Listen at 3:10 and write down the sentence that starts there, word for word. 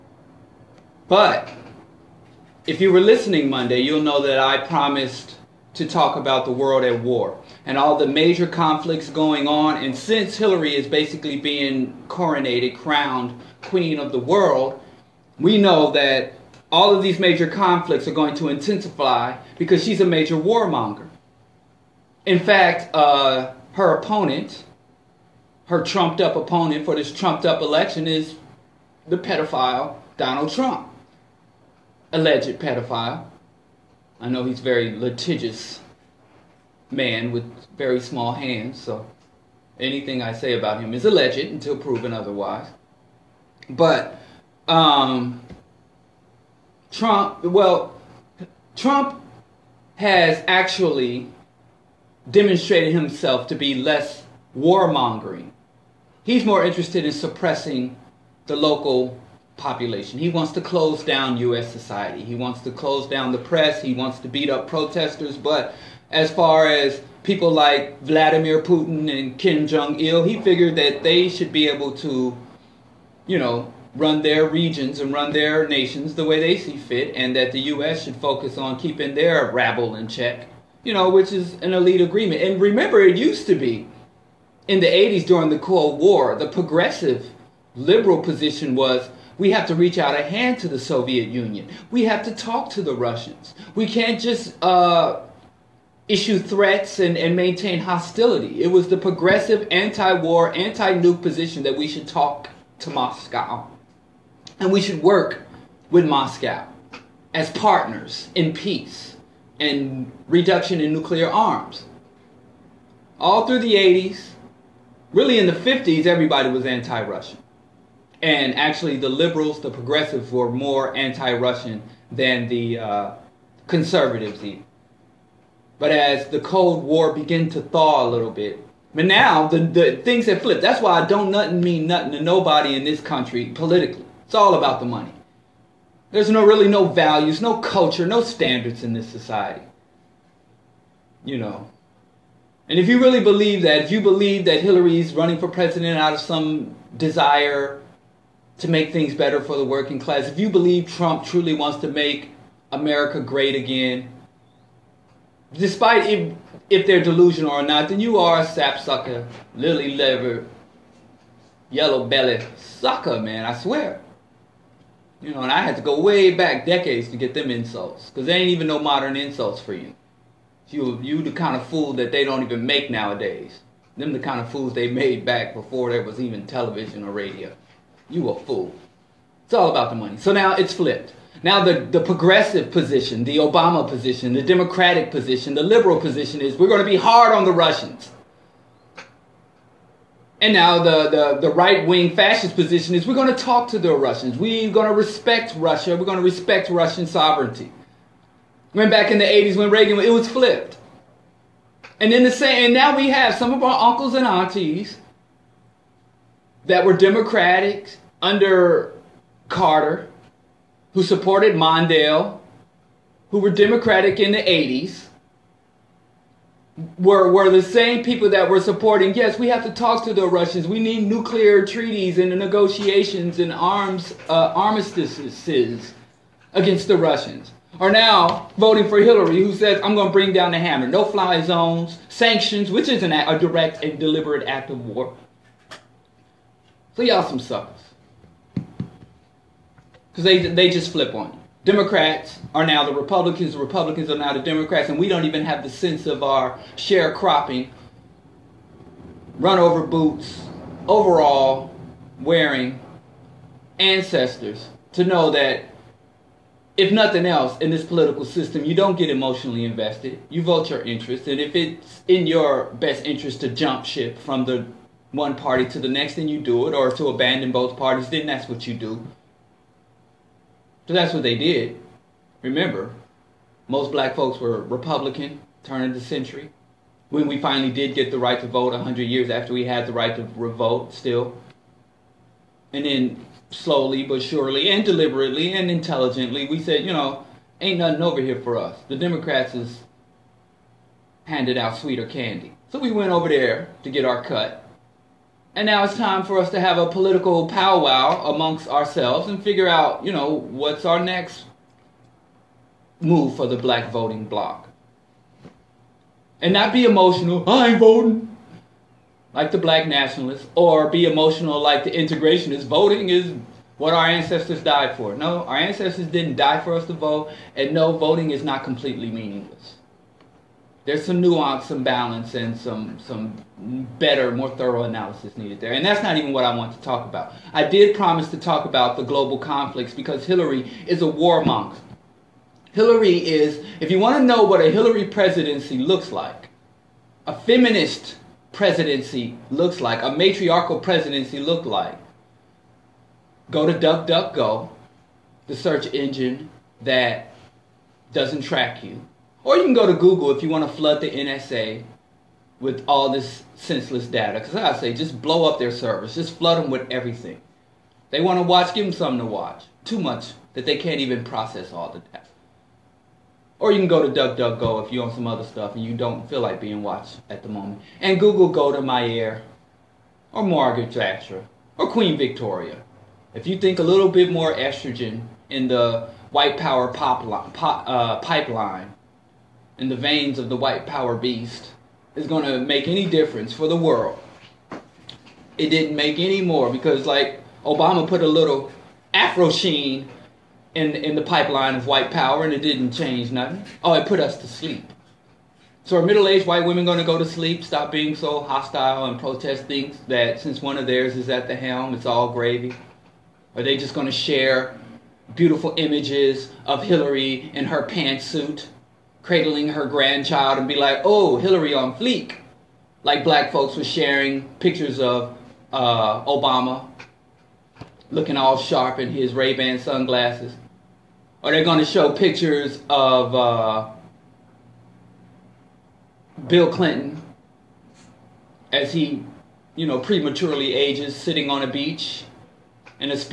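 And now, the, the, the right wing fascist position is we're going to talk to the Russians.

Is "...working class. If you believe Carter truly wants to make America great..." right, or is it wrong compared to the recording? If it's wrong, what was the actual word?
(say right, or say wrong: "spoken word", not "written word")
wrong: "Trump", not "Carter".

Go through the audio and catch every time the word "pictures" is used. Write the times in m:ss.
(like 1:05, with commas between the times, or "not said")
6:54, 7:02.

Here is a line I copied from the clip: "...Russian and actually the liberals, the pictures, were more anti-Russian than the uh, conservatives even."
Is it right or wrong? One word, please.
wrong.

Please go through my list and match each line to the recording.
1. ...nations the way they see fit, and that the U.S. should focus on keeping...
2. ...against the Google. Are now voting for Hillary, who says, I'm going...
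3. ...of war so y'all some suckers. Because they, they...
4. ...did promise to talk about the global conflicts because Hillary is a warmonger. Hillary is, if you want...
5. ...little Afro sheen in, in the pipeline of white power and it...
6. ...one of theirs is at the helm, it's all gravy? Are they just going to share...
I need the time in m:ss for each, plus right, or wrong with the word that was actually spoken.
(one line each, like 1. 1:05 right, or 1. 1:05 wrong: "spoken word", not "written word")
1. 1:15 right
2. 3:46 wrong: "Russians", not "Google"
3. 3:54 right
4. 5:27 right
5. 6:28 right
6. 6:40 right.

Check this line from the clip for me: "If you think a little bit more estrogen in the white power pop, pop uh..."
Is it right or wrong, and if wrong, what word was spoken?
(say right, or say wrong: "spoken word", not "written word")
right.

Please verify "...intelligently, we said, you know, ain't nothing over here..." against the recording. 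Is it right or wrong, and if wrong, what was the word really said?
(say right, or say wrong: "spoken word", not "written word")
right.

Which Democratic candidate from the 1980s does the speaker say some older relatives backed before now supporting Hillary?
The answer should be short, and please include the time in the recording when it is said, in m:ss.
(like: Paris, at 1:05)
Mondale, at 3:31.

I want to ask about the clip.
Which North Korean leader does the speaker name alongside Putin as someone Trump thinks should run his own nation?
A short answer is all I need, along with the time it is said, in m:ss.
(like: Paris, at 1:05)
Kim Jong il, at 1:09.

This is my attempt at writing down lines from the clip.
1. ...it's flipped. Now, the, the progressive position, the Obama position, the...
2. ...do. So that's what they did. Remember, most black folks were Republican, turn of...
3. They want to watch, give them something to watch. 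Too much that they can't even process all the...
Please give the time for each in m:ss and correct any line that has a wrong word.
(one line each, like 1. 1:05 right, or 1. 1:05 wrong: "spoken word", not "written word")
1. 3:00 right
2. 4:28 right
3. 5:58 right.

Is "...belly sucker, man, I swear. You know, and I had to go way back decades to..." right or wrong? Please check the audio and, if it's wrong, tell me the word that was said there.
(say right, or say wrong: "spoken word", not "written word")
right.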